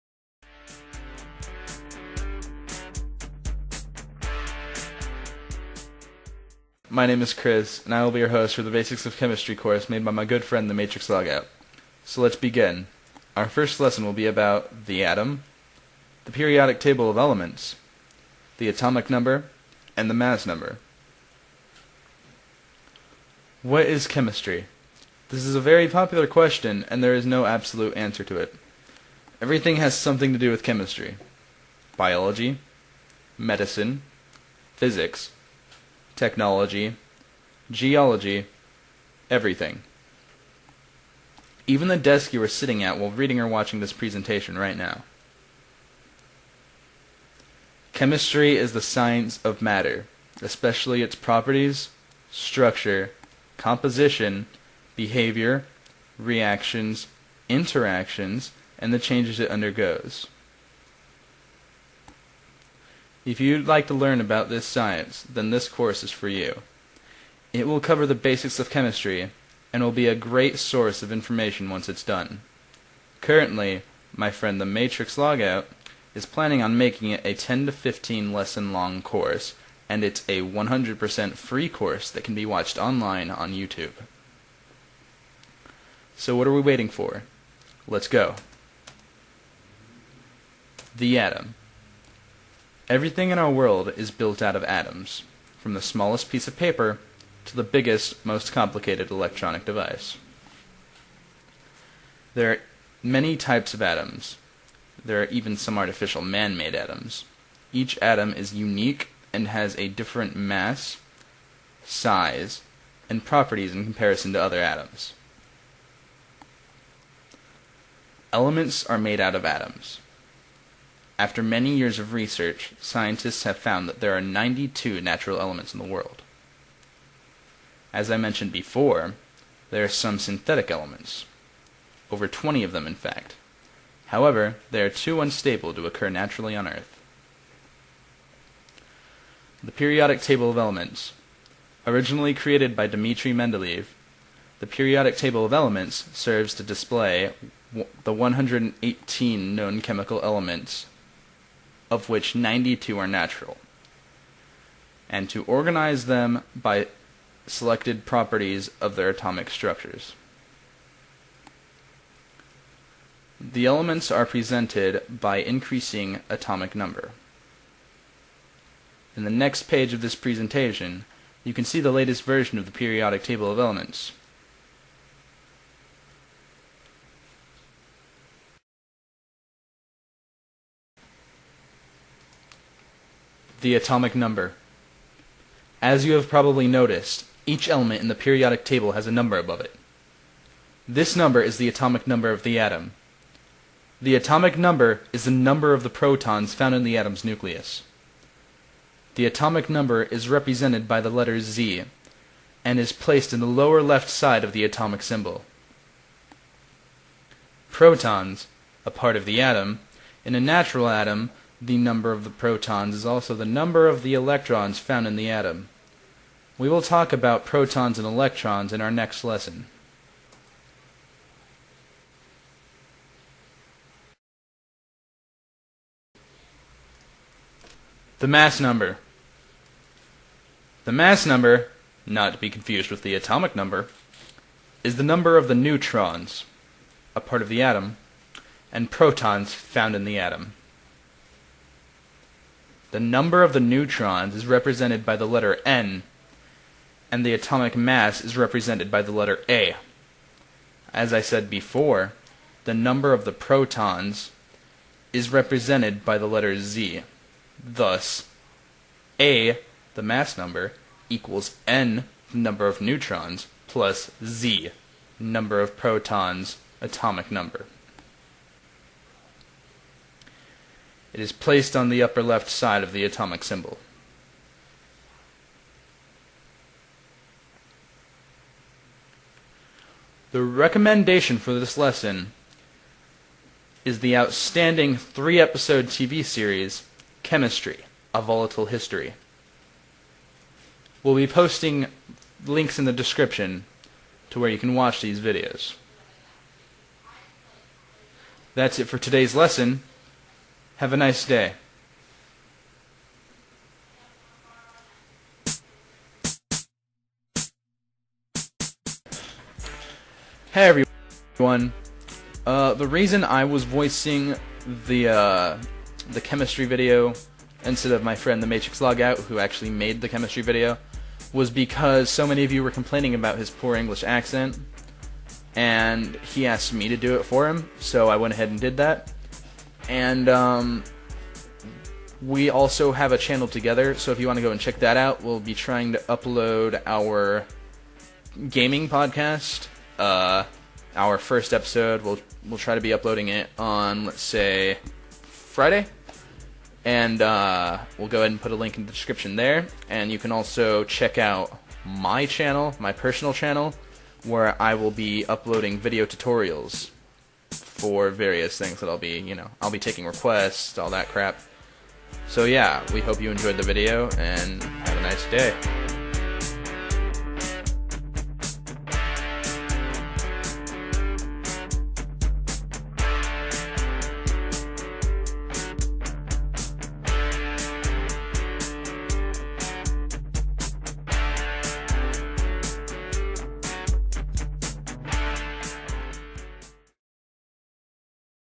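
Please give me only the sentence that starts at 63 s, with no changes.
If you'd like to learn about this science, then this course is for you.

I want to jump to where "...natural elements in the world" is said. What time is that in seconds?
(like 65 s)
125 s.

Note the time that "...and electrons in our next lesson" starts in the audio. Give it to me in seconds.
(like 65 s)
217 s.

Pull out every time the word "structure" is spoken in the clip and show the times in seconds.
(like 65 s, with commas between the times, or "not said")
52 s, 159 s.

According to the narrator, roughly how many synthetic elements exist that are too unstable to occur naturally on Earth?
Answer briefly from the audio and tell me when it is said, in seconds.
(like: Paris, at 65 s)
over 20, at 132 s.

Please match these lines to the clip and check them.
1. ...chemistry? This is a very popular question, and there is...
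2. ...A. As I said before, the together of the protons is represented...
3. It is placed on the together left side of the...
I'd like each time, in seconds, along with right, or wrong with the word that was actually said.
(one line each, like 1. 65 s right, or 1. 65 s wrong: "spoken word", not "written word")
1. 24 s right
2. 249 s wrong: "number", not "together"
3. 271 s wrong: "upper", not "together".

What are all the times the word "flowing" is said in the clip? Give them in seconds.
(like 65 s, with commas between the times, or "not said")
not said.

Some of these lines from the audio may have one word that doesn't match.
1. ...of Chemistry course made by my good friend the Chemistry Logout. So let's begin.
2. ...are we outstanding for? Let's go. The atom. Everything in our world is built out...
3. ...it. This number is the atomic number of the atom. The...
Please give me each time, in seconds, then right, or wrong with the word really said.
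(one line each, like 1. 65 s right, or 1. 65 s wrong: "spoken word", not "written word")
1. 9 s wrong: "Matrix", not "Chemistry"
2. 86 s wrong: "waiting", not "outstanding"
3. 189 s right.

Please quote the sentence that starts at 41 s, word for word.
Even the desk you are sitting at while reading or watching this presentation right now.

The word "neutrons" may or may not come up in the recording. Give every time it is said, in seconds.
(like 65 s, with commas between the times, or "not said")
235 s, 243 s, 262 s.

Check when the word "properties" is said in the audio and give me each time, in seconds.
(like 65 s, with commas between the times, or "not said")
51 s, 113 s, 158 s.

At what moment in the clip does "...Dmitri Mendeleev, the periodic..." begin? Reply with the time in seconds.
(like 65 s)
142 s.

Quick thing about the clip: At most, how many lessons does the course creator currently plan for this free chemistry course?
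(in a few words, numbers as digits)
15.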